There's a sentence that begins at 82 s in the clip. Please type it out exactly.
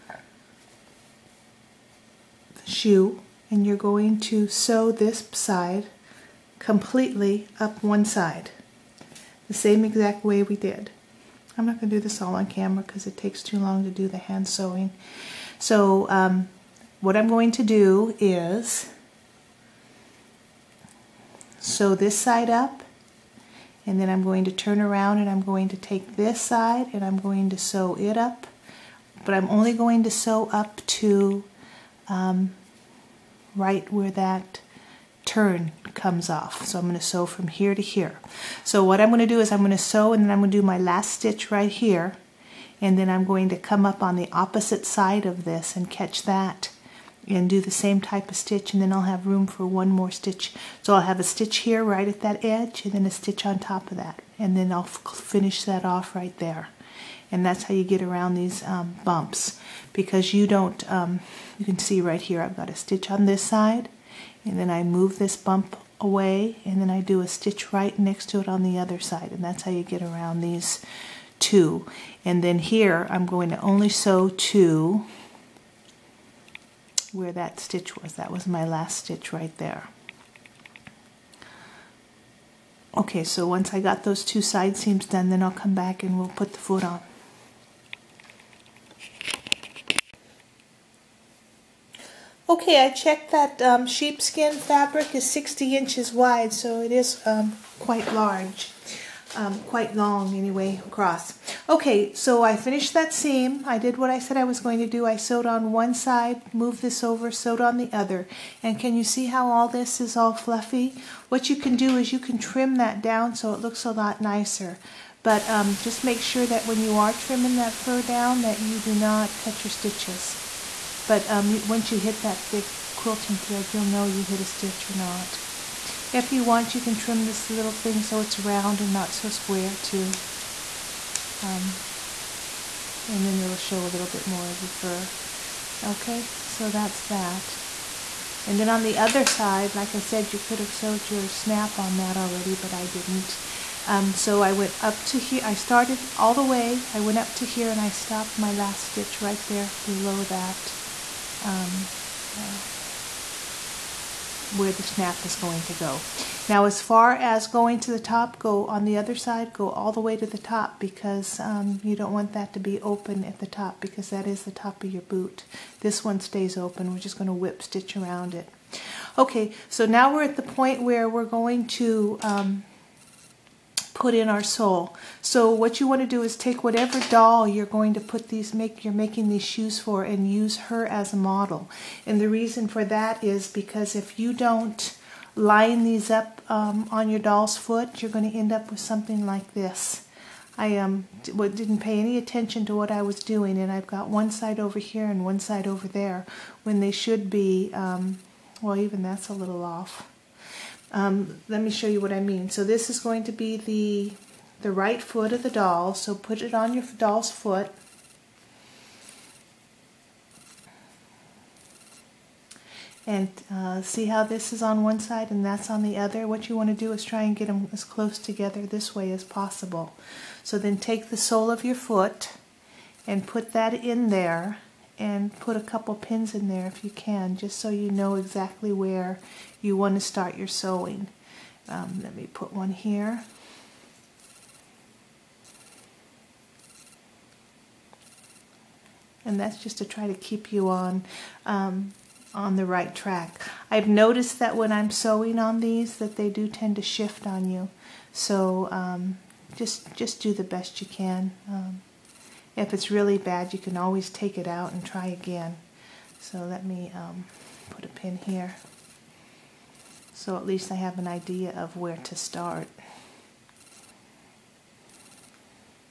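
Okay, so once I got those two side seams done, then I'll come back and we'll put the foot on.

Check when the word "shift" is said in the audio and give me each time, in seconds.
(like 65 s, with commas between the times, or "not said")
246 s.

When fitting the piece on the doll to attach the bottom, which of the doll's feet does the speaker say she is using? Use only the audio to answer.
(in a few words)
right foot.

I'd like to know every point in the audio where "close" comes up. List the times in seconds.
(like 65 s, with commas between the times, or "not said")
217 s.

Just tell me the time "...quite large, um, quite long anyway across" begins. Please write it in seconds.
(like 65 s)
97 s.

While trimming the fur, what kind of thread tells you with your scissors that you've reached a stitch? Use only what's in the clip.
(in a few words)
quilting thread.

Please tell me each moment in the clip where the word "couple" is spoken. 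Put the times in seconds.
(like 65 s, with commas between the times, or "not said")
225 s.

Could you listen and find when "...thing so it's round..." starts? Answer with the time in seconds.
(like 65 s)
127 s.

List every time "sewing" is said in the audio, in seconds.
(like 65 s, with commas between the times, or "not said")
14 s, 230 s, 244 s.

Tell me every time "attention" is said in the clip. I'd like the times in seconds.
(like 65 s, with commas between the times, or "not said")
192 s.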